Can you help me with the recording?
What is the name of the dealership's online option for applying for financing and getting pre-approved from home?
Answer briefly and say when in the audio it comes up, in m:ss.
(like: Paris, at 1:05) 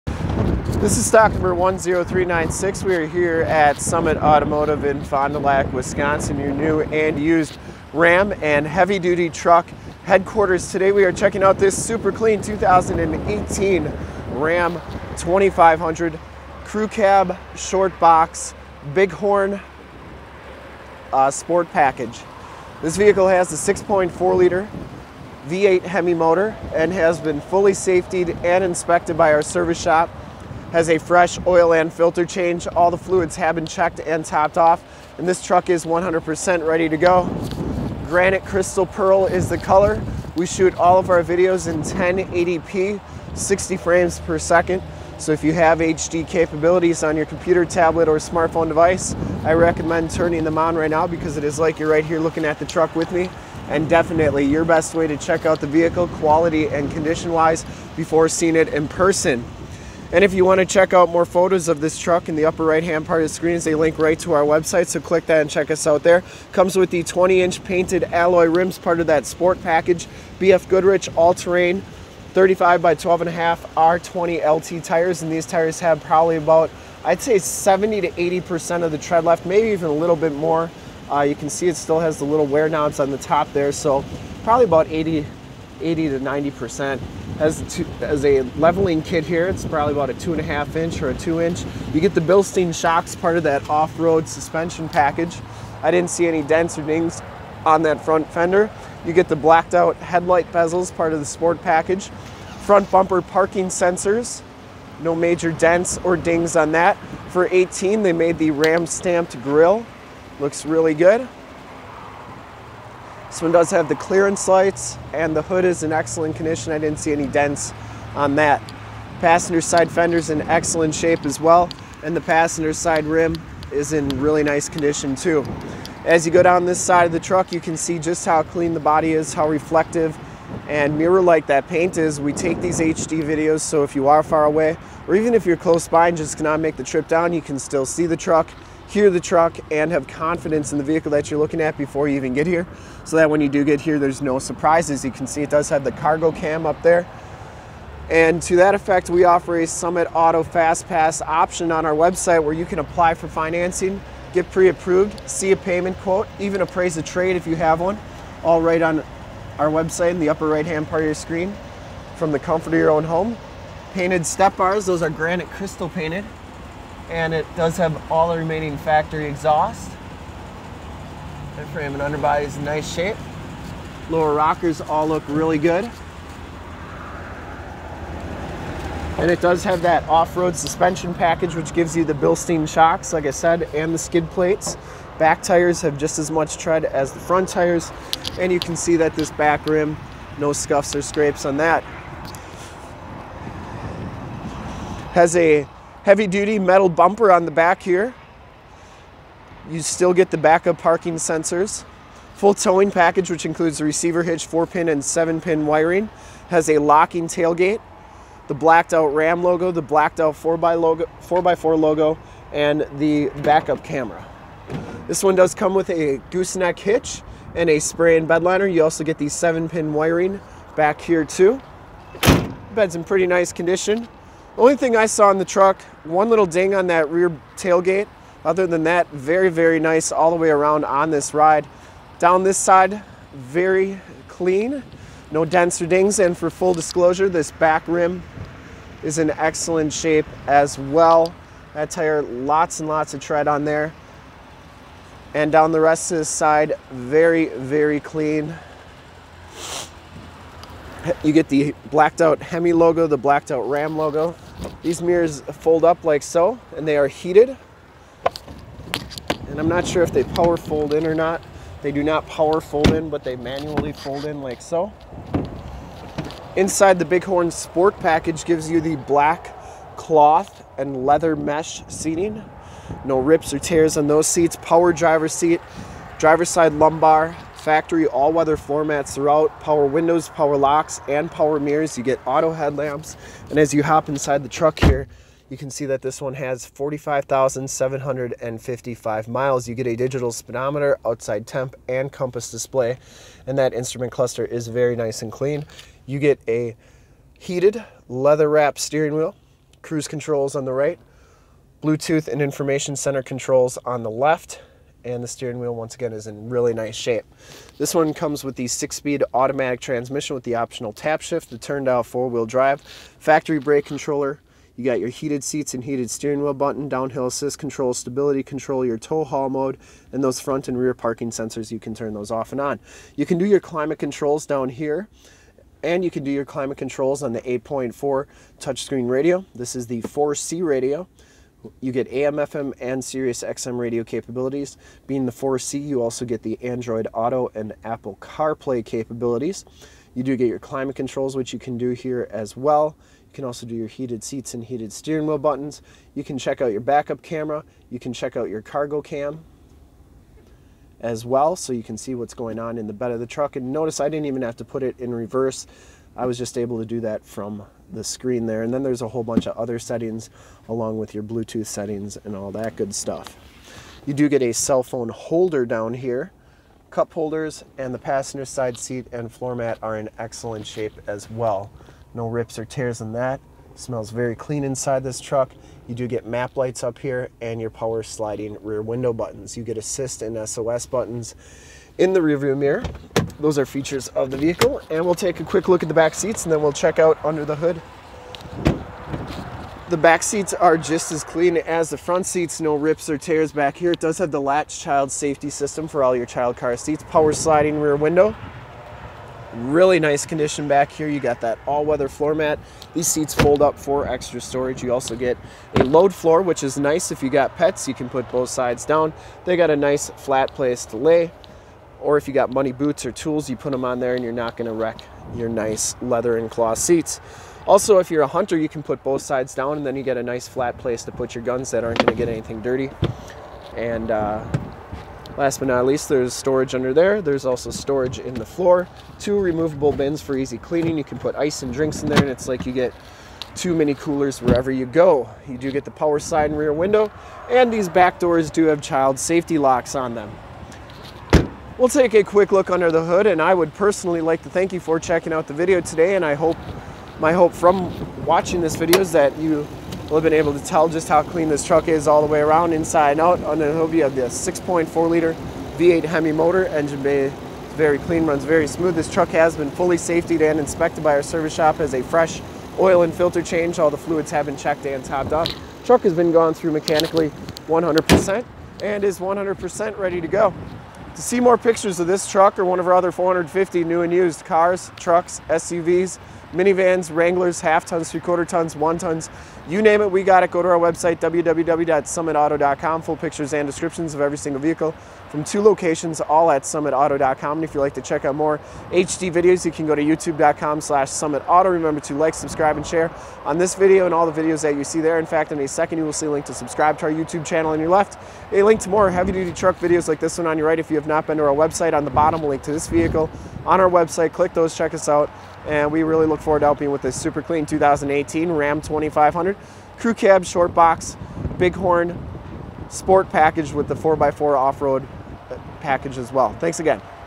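Summit Auto Fast Pass, at 2:29.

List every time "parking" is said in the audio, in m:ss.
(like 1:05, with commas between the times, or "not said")
1:43, 3:20, 5:20.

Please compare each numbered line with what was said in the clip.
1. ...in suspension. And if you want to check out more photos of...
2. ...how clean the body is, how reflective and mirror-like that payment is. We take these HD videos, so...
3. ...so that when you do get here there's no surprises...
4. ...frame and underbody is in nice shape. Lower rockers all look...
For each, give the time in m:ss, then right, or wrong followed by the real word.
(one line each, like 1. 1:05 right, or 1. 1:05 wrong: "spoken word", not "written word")
1. 0:58 wrong: "person", not "suspension"
2. 2:08 wrong: "paint", not "payment"
3. 2:23 right
4. 2:51 right.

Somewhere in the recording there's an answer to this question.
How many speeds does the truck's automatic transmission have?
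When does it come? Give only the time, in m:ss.
5:08.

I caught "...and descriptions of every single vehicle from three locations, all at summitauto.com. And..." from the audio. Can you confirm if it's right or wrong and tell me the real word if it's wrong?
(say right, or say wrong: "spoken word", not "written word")
wrong: "two", not "three".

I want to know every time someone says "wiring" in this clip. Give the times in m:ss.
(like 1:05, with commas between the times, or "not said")
3:25, 3:39.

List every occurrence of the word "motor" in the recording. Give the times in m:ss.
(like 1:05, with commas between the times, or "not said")
0:26, 7:36.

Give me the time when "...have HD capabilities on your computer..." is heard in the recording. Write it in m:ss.
0:45.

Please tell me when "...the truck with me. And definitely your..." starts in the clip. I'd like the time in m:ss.
0:52.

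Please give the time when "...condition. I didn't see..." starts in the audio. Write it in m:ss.
1:56.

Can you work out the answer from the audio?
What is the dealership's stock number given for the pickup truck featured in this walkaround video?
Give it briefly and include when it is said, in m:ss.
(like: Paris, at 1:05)
10396, at 0:01.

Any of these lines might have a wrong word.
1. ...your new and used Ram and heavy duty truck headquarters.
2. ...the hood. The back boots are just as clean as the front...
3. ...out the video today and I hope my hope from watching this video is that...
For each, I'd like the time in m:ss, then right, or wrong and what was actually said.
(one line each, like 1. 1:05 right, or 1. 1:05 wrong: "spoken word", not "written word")
1. 0:06 right
2. 6:27 wrong: "seats", not "boots"
3. 7:25 right.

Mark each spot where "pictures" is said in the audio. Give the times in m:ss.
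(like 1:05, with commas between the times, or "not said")
7:51, 8:03.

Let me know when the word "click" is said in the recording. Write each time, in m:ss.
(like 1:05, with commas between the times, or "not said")
1:04, 8:24.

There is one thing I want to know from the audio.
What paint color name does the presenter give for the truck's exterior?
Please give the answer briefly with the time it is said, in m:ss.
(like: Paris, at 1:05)
Granite Crystal Pearl, at 0:38.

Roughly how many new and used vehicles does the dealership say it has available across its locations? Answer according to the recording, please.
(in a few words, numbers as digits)
450.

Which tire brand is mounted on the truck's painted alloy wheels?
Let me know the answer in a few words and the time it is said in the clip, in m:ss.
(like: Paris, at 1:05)
BF Goodrich, at 1:10.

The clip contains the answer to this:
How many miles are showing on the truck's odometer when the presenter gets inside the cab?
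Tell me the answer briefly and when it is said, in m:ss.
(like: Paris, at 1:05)
45,755, at 4:46.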